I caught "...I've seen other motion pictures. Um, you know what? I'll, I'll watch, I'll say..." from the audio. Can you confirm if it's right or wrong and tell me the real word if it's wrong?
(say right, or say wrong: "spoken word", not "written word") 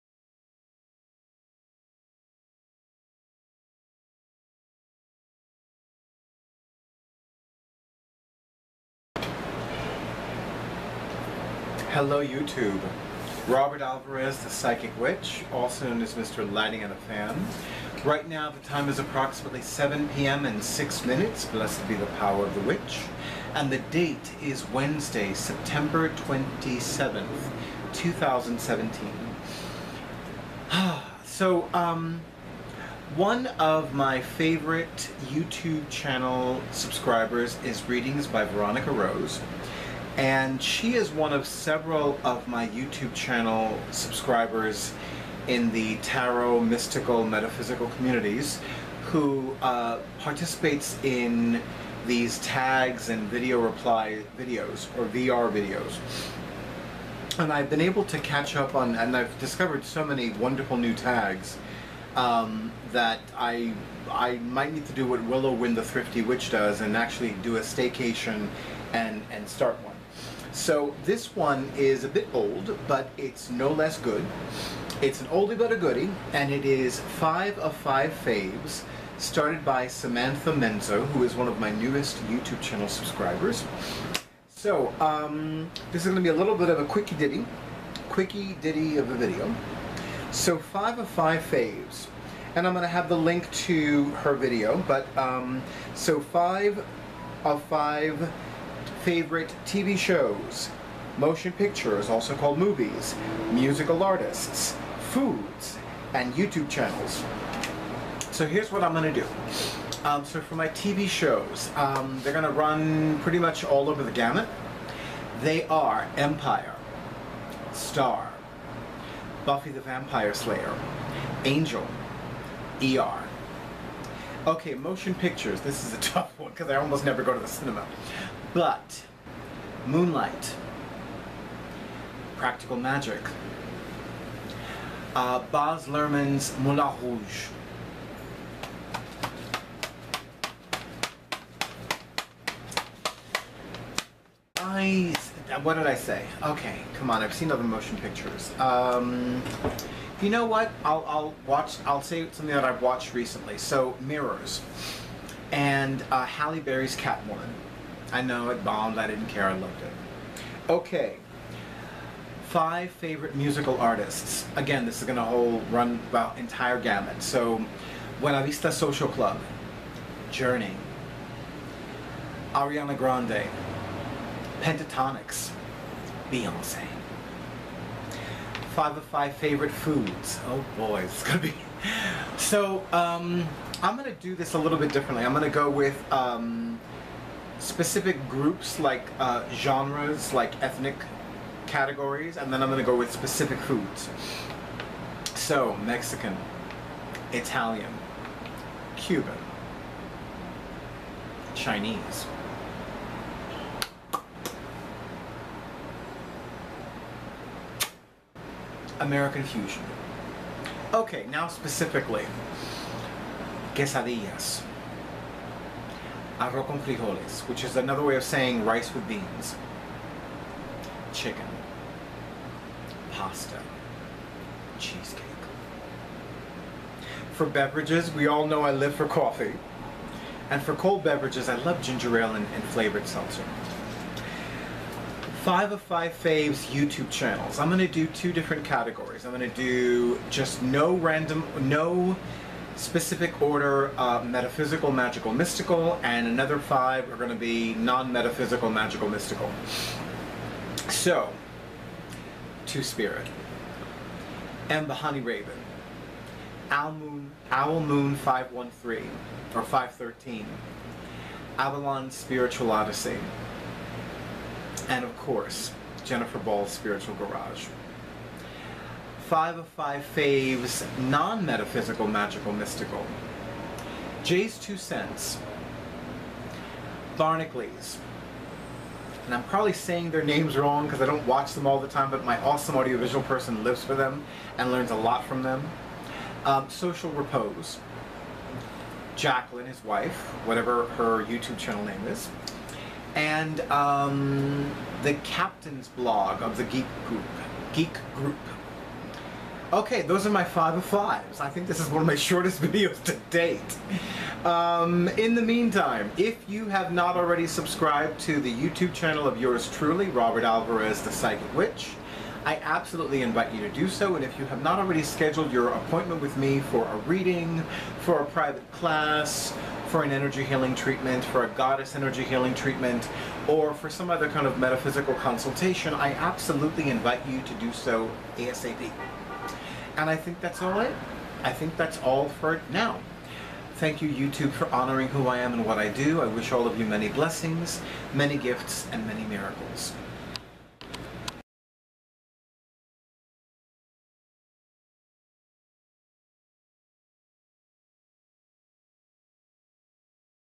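right.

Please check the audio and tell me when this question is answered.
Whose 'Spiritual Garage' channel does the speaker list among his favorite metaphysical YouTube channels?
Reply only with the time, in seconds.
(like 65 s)
266 s.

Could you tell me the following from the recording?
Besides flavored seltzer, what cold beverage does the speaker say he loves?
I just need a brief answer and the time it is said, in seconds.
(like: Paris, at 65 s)
ginger ale, at 231 s.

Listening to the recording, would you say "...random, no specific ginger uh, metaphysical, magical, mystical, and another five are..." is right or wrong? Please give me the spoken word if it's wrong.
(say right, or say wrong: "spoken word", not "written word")
wrong: "order", not "ginger".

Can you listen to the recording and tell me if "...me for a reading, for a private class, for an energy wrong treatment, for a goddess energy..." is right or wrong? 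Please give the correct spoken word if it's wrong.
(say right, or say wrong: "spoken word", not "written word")
wrong: "healing", not "wrong".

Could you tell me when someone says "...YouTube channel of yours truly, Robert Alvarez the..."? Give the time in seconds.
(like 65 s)
308 s.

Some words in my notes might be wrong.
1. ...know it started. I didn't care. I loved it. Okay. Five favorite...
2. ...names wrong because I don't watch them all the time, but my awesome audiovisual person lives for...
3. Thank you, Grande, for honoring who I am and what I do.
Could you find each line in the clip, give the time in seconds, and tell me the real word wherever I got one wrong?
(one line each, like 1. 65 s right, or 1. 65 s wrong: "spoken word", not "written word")
1. 158 s wrong: "bombed", not "started"
2. 280 s right
3. 333 s wrong: "YouTube", not "Grande".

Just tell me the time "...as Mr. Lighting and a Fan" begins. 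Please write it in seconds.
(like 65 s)
16 s.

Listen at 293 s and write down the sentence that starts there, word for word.
And um, the captain's blog of the Geek Group.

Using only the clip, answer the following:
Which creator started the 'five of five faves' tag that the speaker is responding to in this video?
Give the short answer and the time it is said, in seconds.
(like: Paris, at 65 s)
Samantha Menzo, at 79 s.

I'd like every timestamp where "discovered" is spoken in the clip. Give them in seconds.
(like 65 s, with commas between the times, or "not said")
59 s.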